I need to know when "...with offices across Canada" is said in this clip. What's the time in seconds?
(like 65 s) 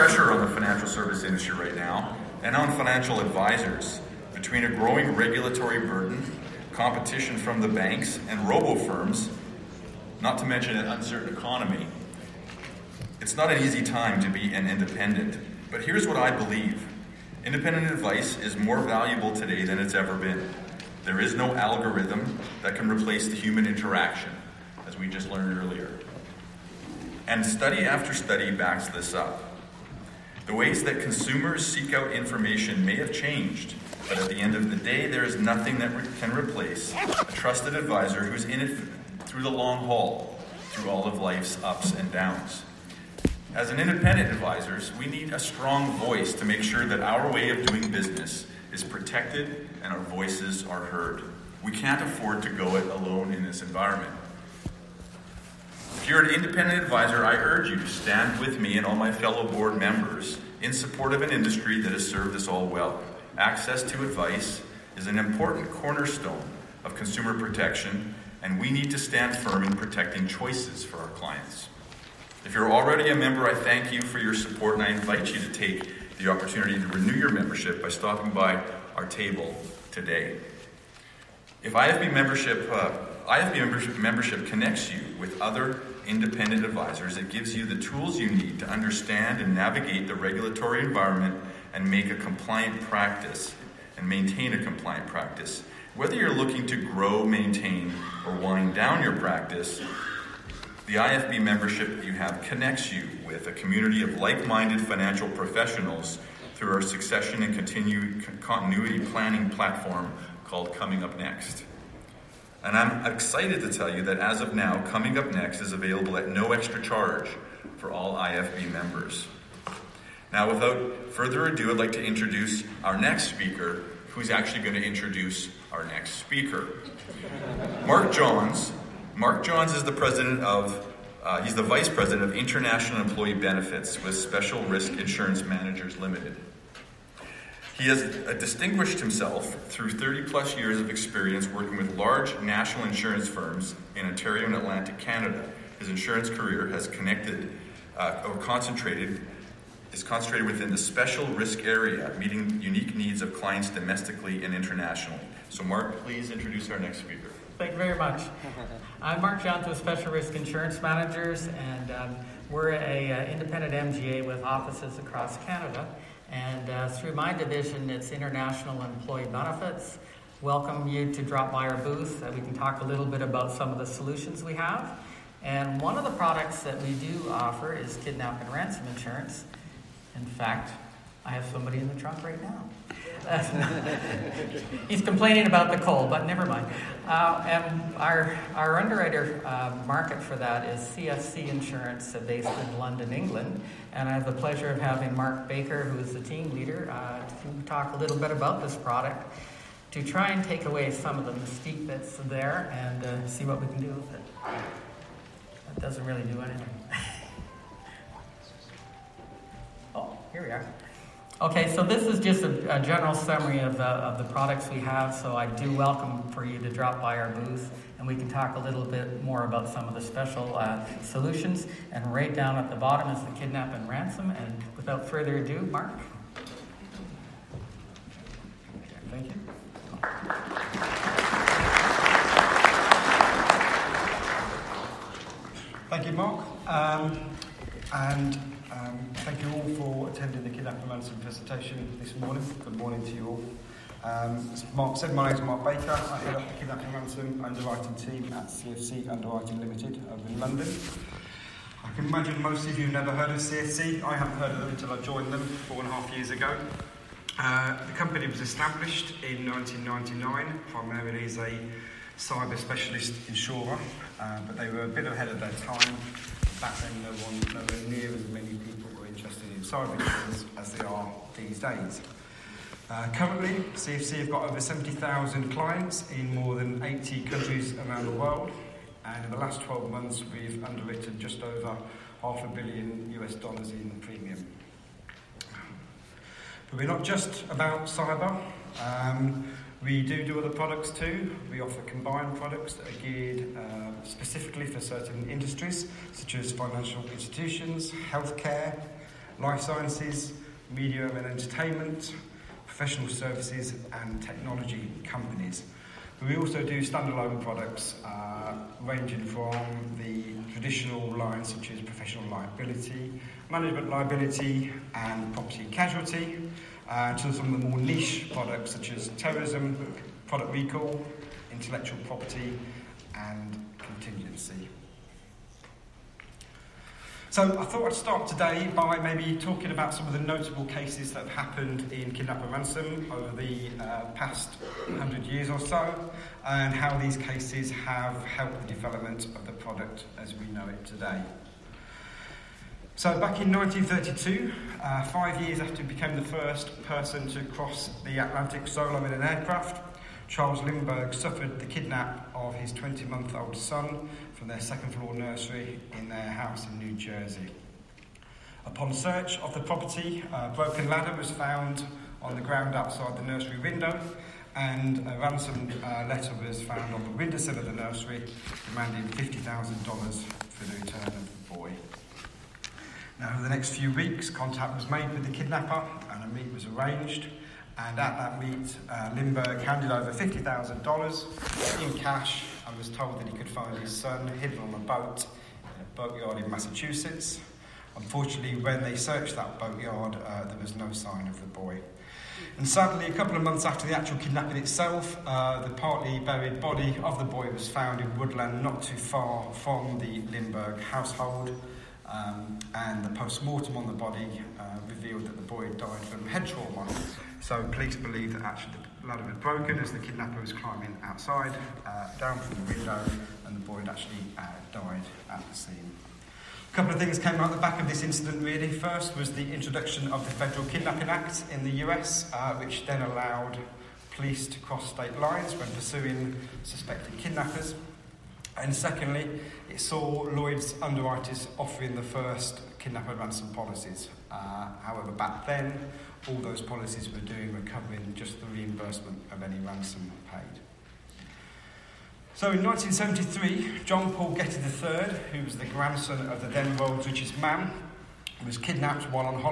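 164 s.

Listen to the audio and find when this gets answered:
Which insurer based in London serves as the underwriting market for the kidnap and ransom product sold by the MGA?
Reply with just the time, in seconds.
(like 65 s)
190 s.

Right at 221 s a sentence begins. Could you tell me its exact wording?
And right down at the bottom is the kidnap and ransom.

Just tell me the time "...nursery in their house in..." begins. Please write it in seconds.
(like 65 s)
355 s.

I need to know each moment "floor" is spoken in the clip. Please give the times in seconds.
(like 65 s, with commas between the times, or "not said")
354 s.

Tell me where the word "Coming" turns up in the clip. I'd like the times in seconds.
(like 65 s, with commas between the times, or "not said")
110 s, 114 s.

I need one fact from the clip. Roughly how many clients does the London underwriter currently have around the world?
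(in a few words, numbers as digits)
70,000.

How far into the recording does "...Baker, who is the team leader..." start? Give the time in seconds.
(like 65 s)
195 s.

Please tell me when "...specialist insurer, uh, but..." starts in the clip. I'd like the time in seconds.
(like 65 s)
262 s.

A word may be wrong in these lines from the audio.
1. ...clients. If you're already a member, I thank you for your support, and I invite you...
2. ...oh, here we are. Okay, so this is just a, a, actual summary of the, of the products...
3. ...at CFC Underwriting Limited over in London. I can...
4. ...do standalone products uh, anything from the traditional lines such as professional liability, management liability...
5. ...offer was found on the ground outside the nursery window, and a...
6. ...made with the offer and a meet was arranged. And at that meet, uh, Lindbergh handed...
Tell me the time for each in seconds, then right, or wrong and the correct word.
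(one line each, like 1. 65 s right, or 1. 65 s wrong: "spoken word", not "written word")
1. 71 s right
2. 209 s wrong: "general", not "actual"
3. 248 s right
4. 306 s wrong: "ranging", not "anything"
5. 360 s wrong: "ladder", not "offer"
6. 374 s wrong: "kidnapper", not "offer".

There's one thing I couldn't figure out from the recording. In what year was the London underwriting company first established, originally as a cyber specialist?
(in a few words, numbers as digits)
1999.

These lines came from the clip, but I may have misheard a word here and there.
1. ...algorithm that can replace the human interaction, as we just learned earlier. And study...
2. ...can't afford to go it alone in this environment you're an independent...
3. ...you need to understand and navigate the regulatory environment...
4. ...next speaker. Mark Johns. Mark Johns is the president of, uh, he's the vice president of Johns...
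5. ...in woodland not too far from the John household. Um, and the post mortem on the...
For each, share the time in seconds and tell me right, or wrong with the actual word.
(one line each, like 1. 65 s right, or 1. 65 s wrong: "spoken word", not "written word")
1. 21 s right
2. 51 s right
3. 88 s right
4. 125 s wrong: "International", not "Johns"
5. 397 s wrong: "Lindbergh", not "John".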